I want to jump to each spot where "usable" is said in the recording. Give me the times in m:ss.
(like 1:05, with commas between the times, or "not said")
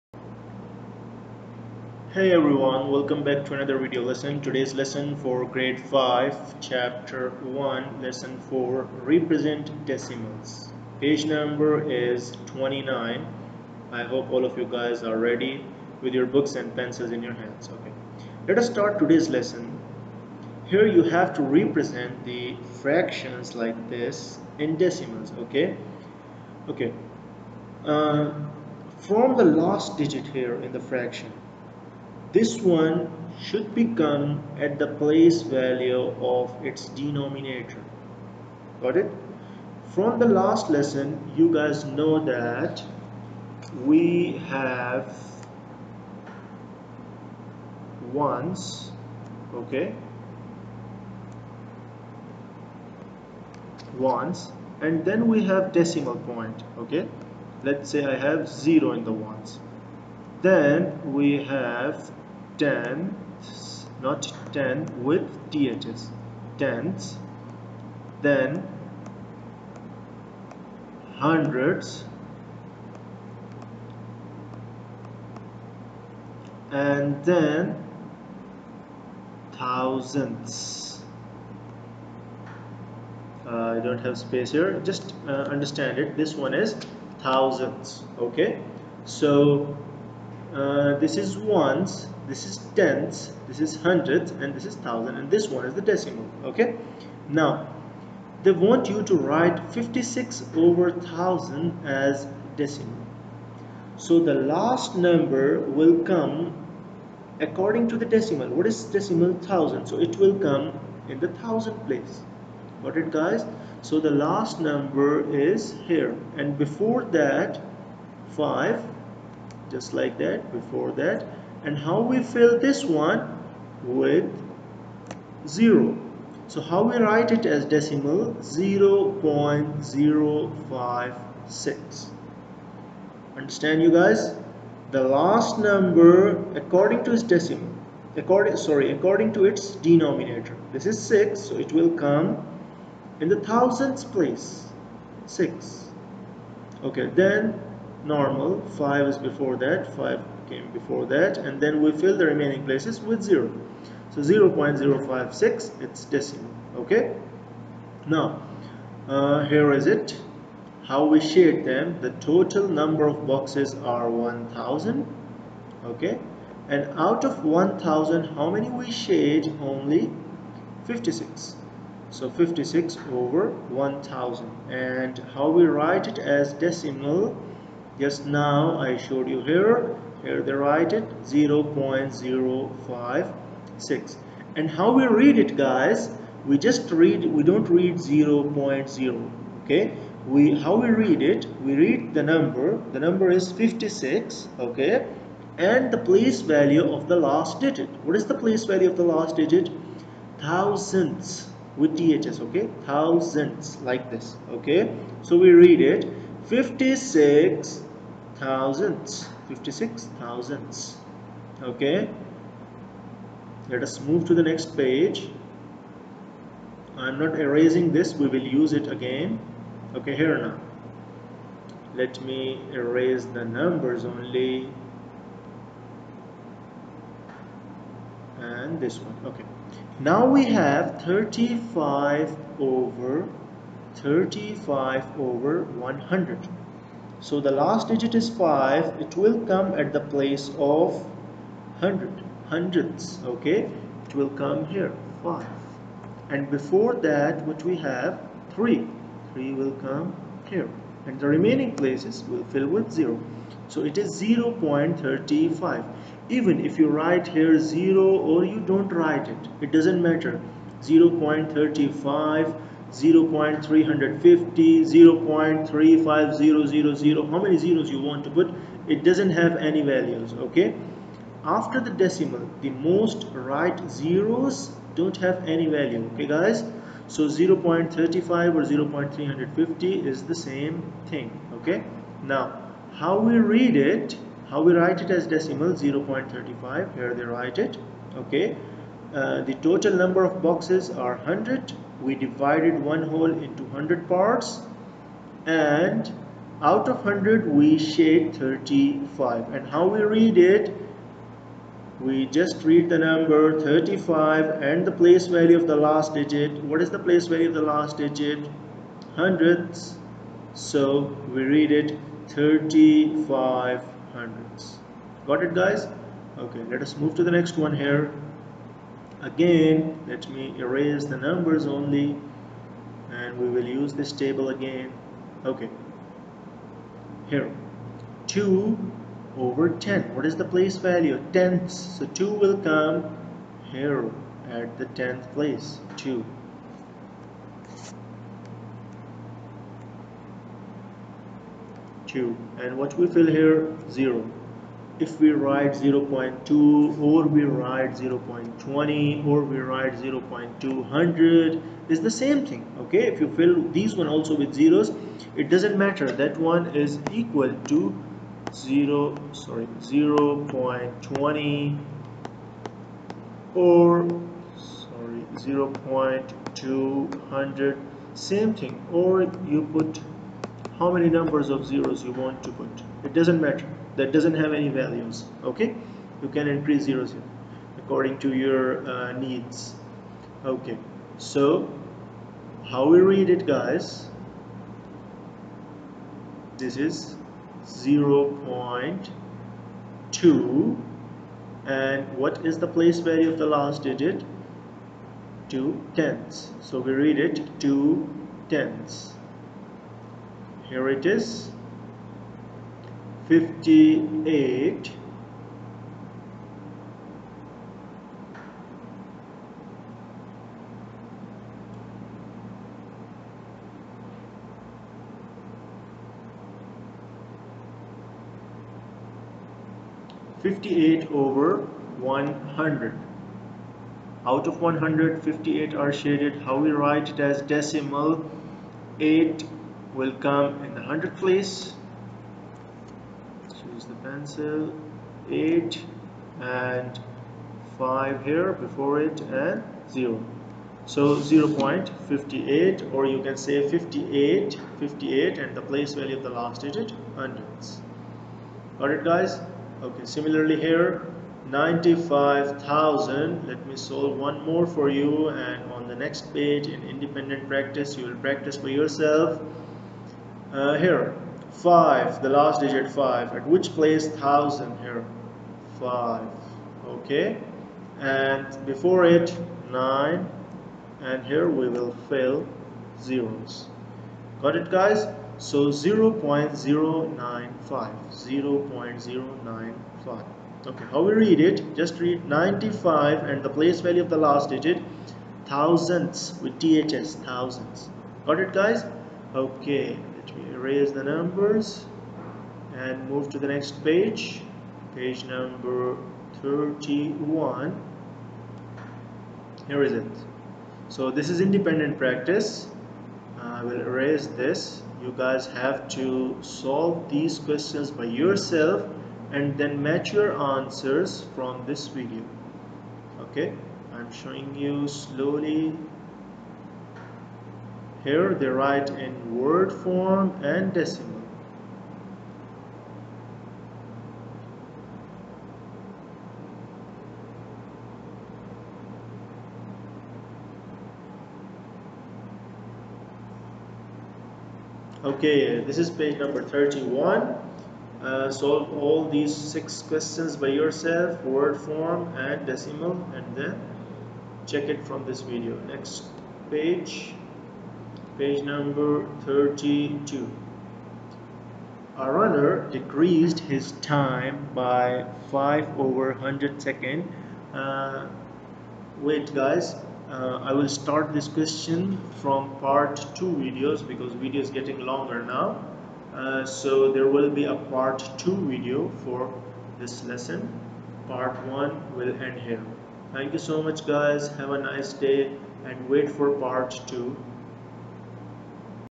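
not said.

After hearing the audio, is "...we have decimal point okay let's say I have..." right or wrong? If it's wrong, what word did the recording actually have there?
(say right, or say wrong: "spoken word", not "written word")
right.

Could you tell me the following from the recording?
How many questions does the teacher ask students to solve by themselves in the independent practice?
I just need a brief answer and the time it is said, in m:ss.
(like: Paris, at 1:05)
six, at 8:59.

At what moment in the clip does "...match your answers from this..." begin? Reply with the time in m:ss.
8:29.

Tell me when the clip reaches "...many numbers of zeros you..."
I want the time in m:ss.
6:10.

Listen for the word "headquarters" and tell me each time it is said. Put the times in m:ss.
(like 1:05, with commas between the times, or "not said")
not said.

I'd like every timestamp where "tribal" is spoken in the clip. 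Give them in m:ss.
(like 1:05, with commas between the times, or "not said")
not said.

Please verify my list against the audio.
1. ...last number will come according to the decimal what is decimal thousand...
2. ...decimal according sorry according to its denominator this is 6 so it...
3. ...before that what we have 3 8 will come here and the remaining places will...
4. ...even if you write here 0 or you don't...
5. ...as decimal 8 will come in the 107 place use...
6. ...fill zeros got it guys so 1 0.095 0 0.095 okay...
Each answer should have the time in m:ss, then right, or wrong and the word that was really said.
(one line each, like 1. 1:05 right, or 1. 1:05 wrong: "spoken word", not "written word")
1. 1:44 right
2. 2:17 right
3. 4:06 wrong: "3", not "8"
4. 4:16 right
5. 7:07 wrong: "100", not "107"
6. 7:52 wrong: "0", not "1".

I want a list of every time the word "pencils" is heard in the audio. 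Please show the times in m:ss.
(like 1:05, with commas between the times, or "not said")
0:16, 7:14.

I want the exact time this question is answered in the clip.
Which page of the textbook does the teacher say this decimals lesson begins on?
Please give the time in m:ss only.
0:10.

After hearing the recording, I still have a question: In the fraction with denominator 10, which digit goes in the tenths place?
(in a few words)
2.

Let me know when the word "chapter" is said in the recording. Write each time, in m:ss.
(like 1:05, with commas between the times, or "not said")
0:06.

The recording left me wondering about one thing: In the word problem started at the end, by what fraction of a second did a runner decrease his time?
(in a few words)
5/100.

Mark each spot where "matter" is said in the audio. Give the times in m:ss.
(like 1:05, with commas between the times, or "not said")
4:20, 5:55, 6:13.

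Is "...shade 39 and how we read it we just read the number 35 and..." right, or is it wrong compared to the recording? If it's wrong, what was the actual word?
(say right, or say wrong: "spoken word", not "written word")
wrong: "35", not "39".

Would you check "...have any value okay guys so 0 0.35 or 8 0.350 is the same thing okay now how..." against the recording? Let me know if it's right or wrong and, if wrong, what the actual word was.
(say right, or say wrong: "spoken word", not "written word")
wrong: "0", not "8".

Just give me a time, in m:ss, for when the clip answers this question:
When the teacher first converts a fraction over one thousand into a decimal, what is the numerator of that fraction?
1:39.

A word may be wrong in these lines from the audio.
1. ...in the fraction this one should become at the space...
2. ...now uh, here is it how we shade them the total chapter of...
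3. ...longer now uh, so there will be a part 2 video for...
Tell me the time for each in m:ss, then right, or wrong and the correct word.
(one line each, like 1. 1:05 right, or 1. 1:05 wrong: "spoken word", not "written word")
1. 0:30 wrong: "place", not "space"
2. 2:38 wrong: "number", not "chapter"
3. 9:24 right.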